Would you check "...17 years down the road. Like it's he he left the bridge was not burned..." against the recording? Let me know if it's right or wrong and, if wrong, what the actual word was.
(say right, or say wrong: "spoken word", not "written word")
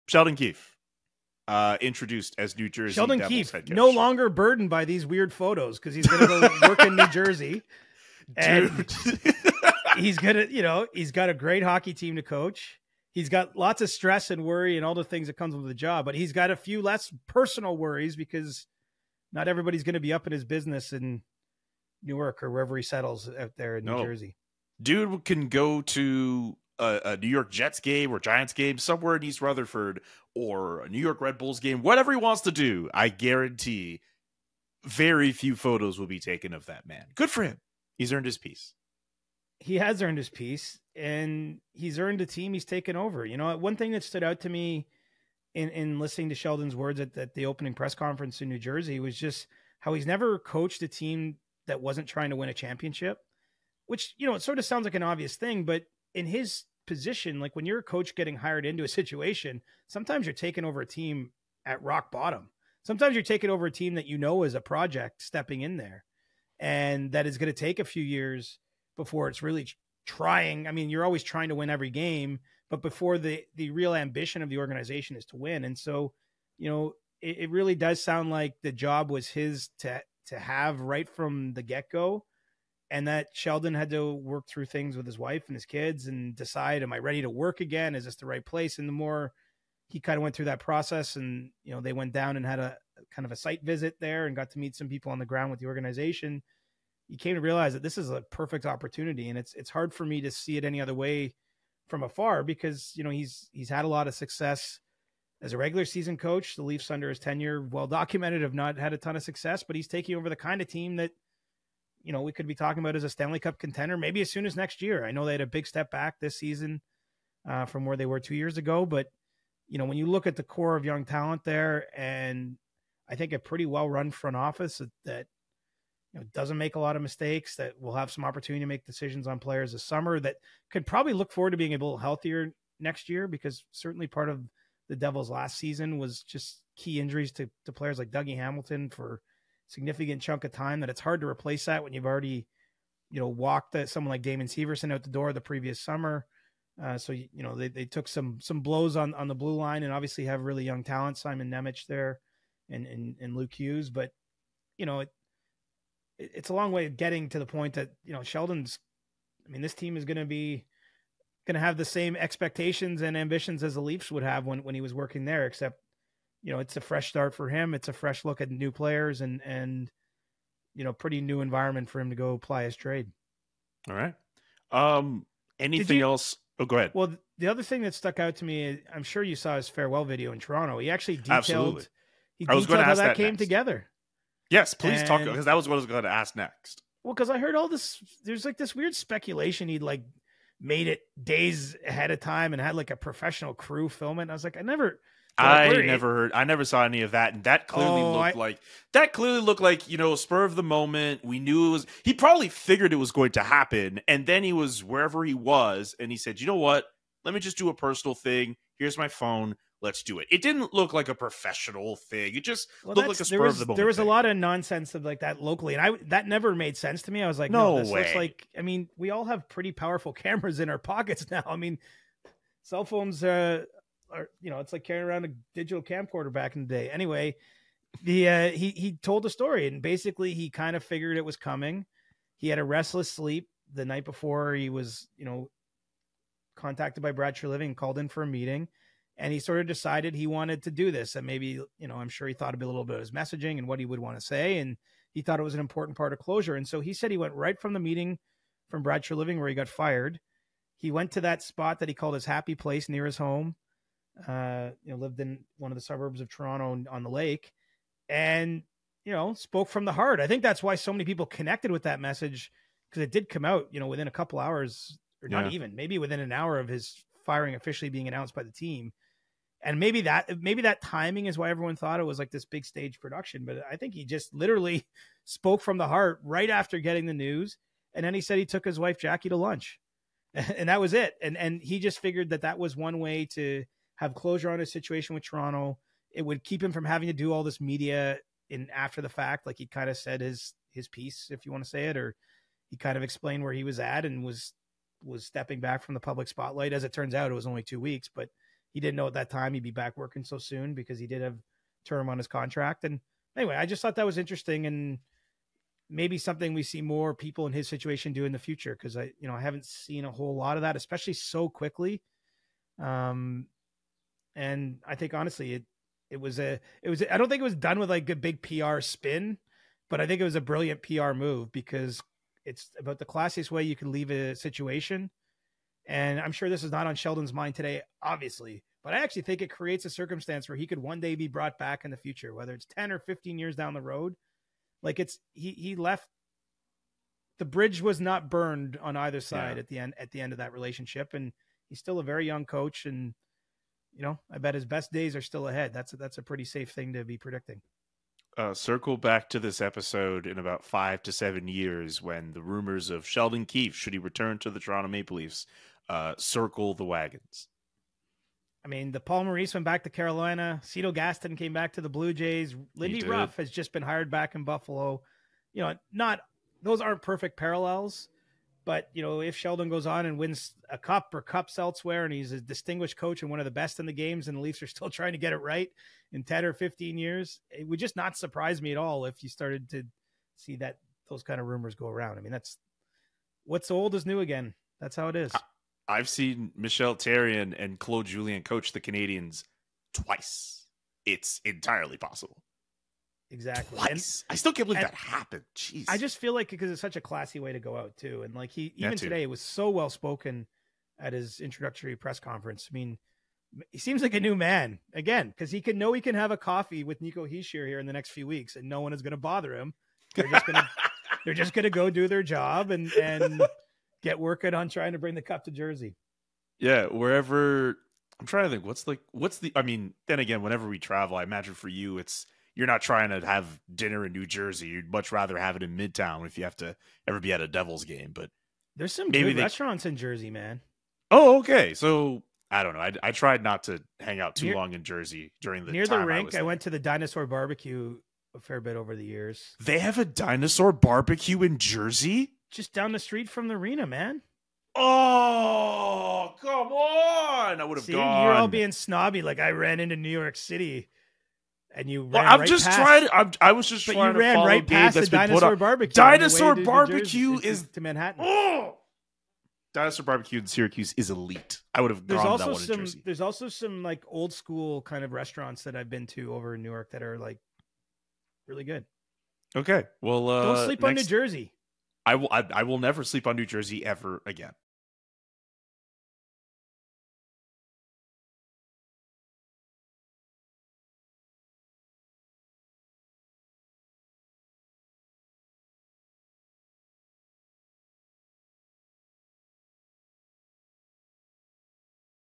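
wrong: "15", not "17".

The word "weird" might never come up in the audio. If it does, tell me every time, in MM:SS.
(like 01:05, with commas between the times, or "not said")
00:05, 03:08.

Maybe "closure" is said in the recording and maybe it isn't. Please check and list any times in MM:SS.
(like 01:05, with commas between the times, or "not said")
04:06, 04:44.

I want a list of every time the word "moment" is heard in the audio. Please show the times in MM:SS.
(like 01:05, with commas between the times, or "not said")
03:20, 03:33.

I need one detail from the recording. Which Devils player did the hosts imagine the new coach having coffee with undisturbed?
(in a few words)
Nico Hischier.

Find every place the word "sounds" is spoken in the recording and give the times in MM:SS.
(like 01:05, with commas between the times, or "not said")
00:54, 01:18.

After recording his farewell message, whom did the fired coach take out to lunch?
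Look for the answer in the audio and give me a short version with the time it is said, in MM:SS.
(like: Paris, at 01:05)
his wife Jackie, at 04:38.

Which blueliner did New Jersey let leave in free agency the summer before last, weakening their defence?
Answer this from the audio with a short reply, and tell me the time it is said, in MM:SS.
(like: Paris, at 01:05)
Damon Severson, at 02:24.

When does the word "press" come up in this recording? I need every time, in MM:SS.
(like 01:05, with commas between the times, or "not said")
00:47, 06:41.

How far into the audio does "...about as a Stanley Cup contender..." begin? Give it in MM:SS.
01:52.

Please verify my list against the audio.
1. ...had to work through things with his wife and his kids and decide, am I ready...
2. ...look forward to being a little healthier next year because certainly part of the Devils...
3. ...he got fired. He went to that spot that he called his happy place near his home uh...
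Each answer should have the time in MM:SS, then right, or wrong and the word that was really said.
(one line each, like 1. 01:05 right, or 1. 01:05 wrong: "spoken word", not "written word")
1. 01:23 right
2. 02:11 right
3. 04:09 right.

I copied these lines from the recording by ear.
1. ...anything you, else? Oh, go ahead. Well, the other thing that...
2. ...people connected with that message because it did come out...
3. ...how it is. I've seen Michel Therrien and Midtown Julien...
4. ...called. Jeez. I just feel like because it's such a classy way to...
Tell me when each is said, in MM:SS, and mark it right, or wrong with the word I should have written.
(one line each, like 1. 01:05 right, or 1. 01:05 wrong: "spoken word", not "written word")
1. 02:55 right
2. 04:21 right
3. 06:24 wrong: "Claude", not "Midtown"
4. 06:34 wrong: "happened", not "called".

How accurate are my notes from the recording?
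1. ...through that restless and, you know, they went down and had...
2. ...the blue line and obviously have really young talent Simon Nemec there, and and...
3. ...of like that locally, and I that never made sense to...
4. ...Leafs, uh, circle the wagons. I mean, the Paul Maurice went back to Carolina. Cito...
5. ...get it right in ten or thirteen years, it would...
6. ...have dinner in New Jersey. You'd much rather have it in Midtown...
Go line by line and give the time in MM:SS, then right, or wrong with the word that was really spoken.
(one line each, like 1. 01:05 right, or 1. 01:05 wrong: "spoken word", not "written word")
1. 01:30 wrong: "process", not "restless"
2. 02:29 right
3. 03:34 right
4. 05:55 right
5. 06:15 wrong: "fifteen", not "thirteen"
6. 07:03 right.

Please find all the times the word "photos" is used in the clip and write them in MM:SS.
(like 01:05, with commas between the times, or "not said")
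00:05, 00:35.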